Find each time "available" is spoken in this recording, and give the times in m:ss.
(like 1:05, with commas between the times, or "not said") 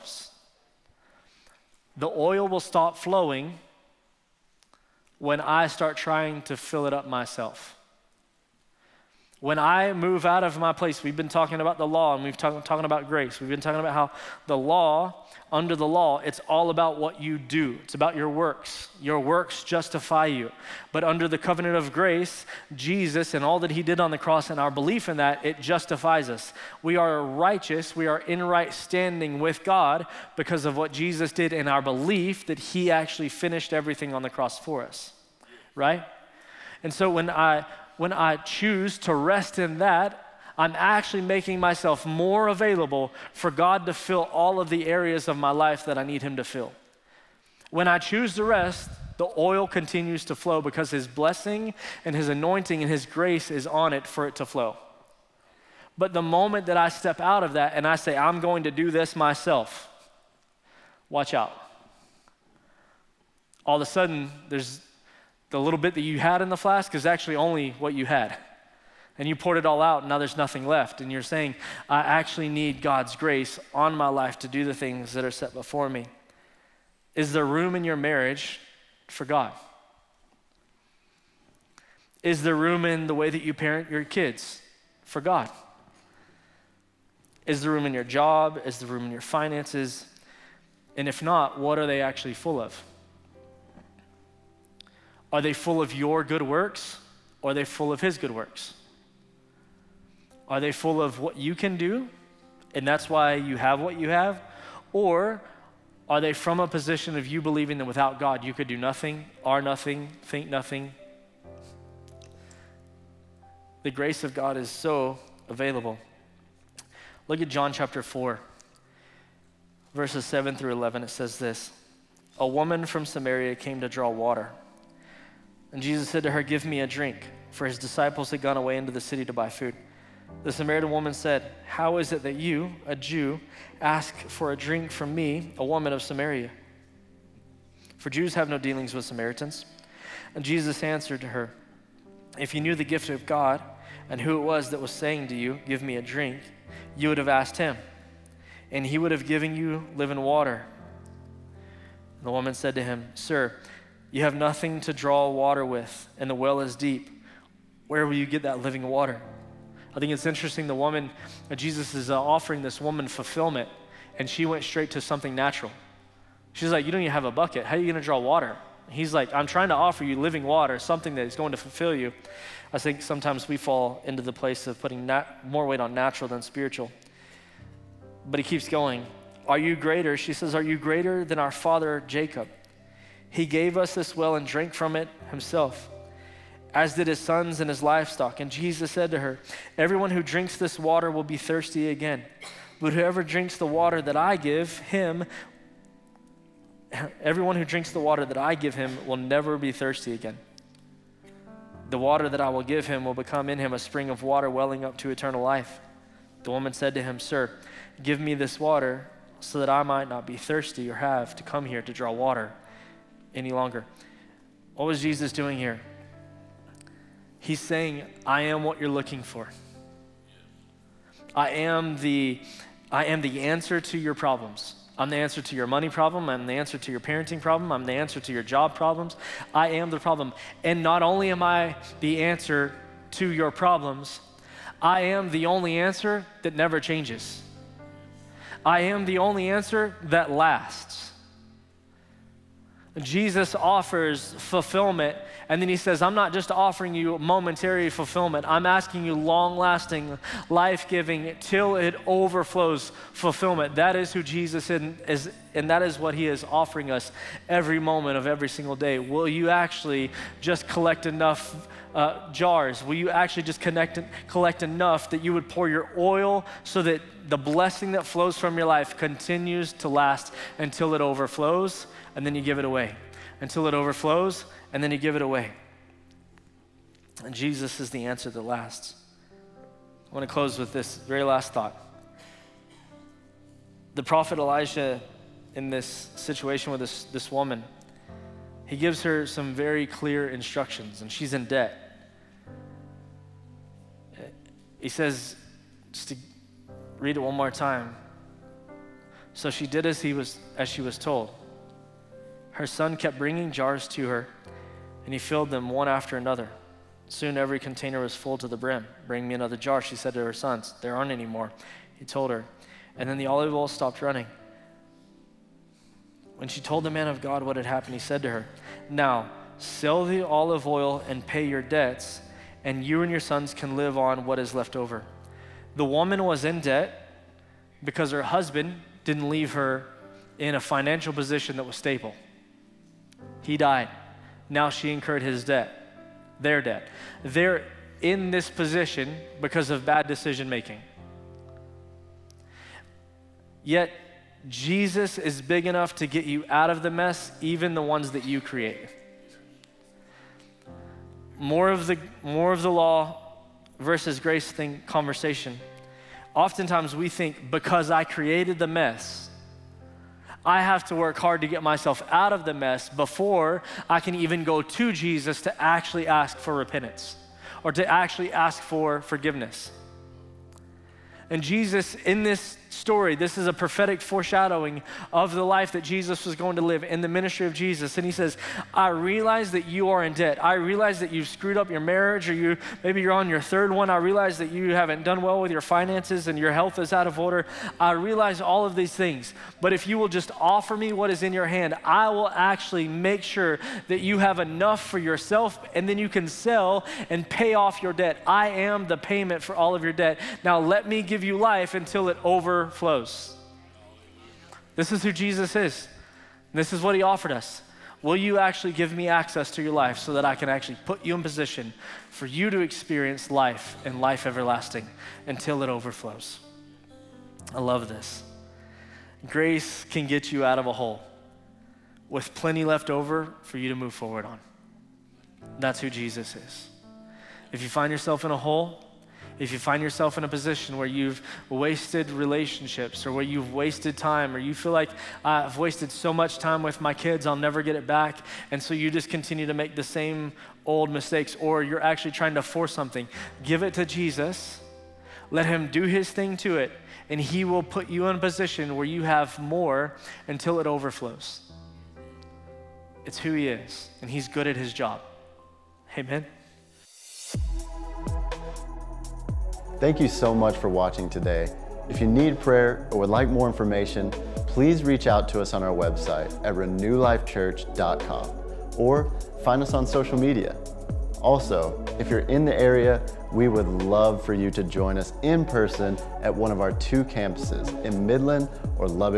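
0:42, 1:55.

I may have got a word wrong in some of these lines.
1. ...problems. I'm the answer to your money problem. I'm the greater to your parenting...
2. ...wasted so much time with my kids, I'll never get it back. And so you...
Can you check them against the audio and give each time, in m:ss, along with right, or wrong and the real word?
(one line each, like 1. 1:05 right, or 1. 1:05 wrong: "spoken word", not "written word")
1. 3:44 wrong: "answer", not "greater"
2. 7:15 right.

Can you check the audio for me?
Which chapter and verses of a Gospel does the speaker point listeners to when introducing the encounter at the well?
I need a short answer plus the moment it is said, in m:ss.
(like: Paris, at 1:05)
John 4:7-11, at 1:57.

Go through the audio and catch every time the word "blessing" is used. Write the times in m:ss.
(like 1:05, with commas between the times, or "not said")
0:51, 4:27.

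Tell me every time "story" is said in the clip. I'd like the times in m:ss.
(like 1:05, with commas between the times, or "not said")
6:12.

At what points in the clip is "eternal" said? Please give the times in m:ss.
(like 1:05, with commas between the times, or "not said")
3:25.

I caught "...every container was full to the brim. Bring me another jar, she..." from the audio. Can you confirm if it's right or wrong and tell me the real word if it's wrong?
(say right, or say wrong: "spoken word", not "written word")
right.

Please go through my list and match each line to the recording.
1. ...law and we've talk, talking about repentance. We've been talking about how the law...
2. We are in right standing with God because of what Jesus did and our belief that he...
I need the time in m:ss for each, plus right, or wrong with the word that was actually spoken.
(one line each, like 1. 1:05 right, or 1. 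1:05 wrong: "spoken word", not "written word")
1. 0:11 wrong: "grace", not "repentance"
2. 0:27 right.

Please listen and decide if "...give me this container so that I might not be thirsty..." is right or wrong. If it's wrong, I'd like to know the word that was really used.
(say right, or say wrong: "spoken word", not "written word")
wrong: "water", not "container".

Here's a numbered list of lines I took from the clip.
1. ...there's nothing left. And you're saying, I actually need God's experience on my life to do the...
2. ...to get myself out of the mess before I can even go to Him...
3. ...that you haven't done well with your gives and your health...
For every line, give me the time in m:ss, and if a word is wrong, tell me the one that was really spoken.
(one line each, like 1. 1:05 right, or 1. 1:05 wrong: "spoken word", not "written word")
1. 1:10 wrong: "grace", not "experience"
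2. 6:01 wrong: "Jesus", not "Him"
3. 6:24 wrong: "finances", not "gives".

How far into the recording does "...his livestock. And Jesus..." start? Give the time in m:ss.
3:07.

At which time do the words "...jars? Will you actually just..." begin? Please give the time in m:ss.
4:22.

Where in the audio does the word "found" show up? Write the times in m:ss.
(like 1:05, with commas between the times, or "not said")
not said.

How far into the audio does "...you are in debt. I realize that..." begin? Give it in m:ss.
6:19.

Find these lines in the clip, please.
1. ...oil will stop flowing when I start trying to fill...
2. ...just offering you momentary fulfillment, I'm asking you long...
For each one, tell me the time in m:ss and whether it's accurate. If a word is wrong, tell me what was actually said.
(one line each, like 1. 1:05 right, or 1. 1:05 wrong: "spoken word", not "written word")
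1. 0:02 right
2. 4:06 right.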